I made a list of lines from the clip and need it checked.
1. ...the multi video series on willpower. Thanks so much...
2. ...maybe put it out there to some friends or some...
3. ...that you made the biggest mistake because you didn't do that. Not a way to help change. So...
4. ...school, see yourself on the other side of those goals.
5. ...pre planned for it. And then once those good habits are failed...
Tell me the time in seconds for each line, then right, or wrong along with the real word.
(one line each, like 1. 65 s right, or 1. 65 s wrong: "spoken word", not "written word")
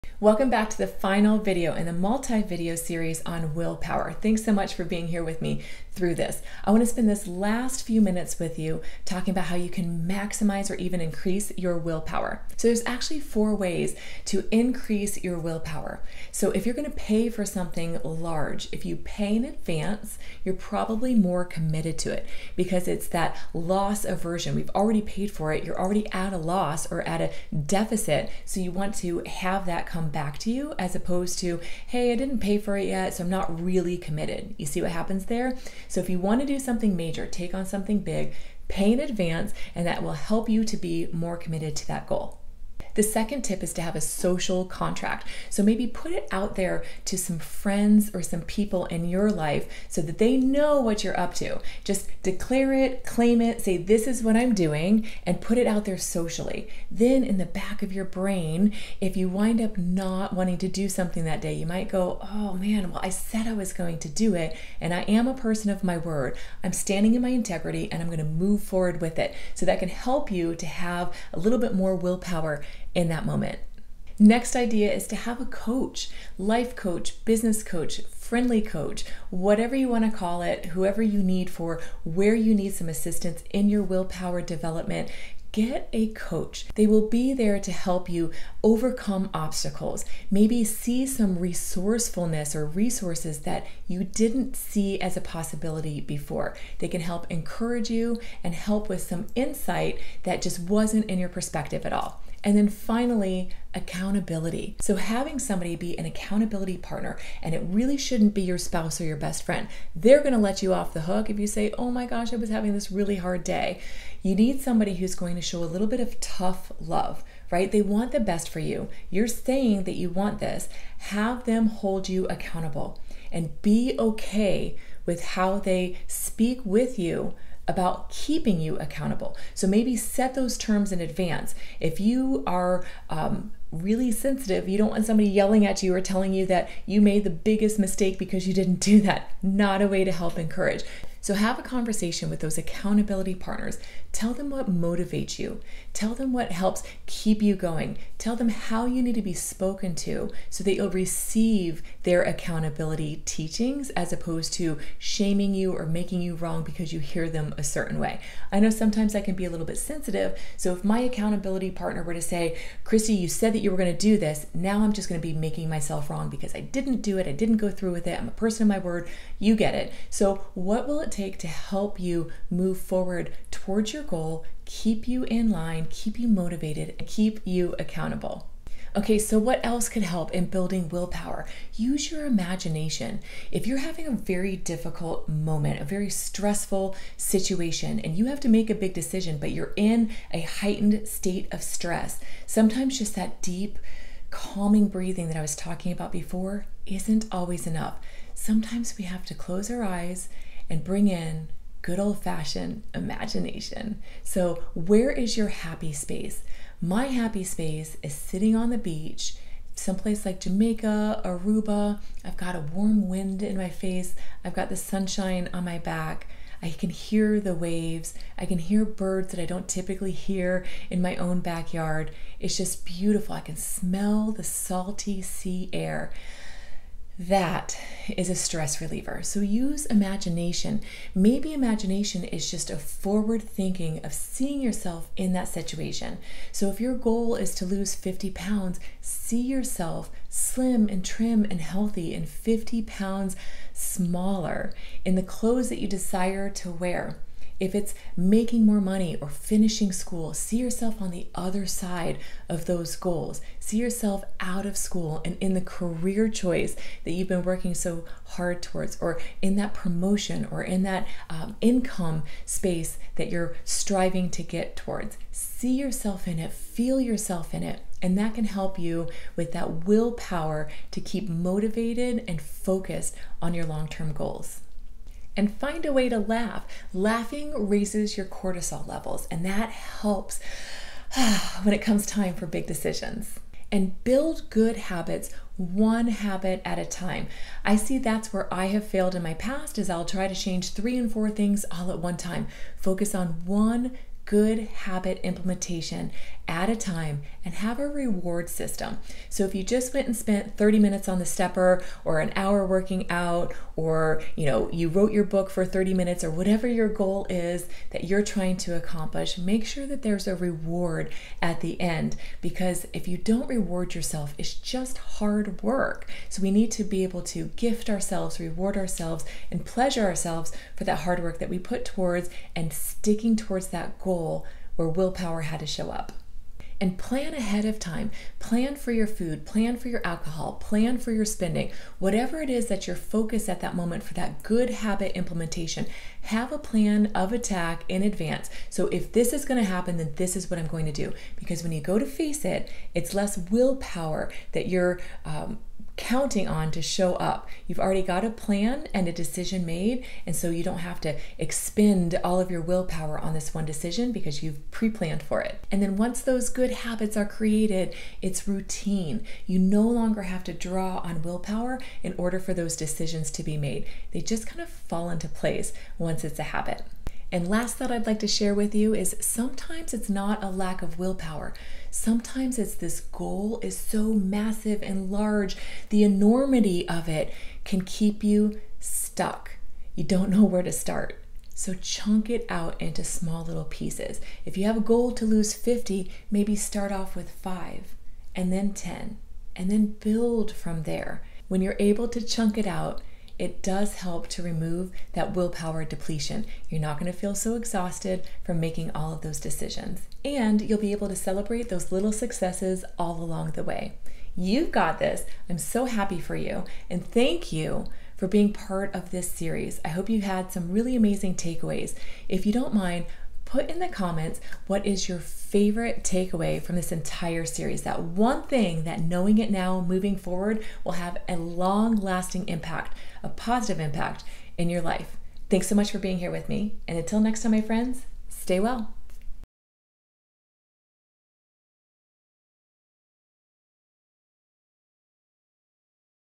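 1. 1 s right
2. 45 s right
3. 136 s wrong: "encourage", not "change"
4. 249 s right
5. 354 s wrong: "created", not "failed".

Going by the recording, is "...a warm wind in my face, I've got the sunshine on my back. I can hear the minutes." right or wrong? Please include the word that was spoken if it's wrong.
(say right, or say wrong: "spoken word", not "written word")
wrong: "waves", not "minutes".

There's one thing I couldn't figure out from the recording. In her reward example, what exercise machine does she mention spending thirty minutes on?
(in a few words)
stepper.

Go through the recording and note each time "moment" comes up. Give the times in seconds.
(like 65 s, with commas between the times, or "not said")
73 s, 185 s, 333 s.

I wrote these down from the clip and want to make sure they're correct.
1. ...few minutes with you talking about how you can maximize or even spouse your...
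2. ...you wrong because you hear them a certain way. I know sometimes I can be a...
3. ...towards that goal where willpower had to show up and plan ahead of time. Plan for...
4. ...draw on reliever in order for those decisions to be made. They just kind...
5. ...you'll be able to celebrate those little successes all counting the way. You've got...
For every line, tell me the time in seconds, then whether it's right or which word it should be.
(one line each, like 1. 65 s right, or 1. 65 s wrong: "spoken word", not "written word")
1. 7 s wrong: "increase", not "spouse"
2. 156 s right
3. 323 s right
4. 360 s wrong: "willpower", not "reliever"
5. 400 s wrong: "along", not "counting".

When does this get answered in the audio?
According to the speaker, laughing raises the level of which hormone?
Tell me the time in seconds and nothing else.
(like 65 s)
278 s.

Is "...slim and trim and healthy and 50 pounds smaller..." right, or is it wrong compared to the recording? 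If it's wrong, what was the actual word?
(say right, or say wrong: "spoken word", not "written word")
right.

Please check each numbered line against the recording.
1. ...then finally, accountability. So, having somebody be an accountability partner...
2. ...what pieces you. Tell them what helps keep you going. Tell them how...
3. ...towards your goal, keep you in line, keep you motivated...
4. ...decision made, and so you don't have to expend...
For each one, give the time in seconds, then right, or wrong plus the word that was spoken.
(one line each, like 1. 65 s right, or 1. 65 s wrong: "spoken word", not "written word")
1. 102 s right
2. 144 s wrong: "motivates", not "pieces"
3. 173 s right
4. 349 s right.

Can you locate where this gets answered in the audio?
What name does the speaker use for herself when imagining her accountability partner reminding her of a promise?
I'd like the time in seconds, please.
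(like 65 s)
162 s.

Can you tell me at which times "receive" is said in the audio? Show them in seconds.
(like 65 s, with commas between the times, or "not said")
150 s.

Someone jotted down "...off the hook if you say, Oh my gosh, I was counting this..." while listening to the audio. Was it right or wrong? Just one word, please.
wrong.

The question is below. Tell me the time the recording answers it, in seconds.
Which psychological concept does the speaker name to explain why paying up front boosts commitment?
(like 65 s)
23 s.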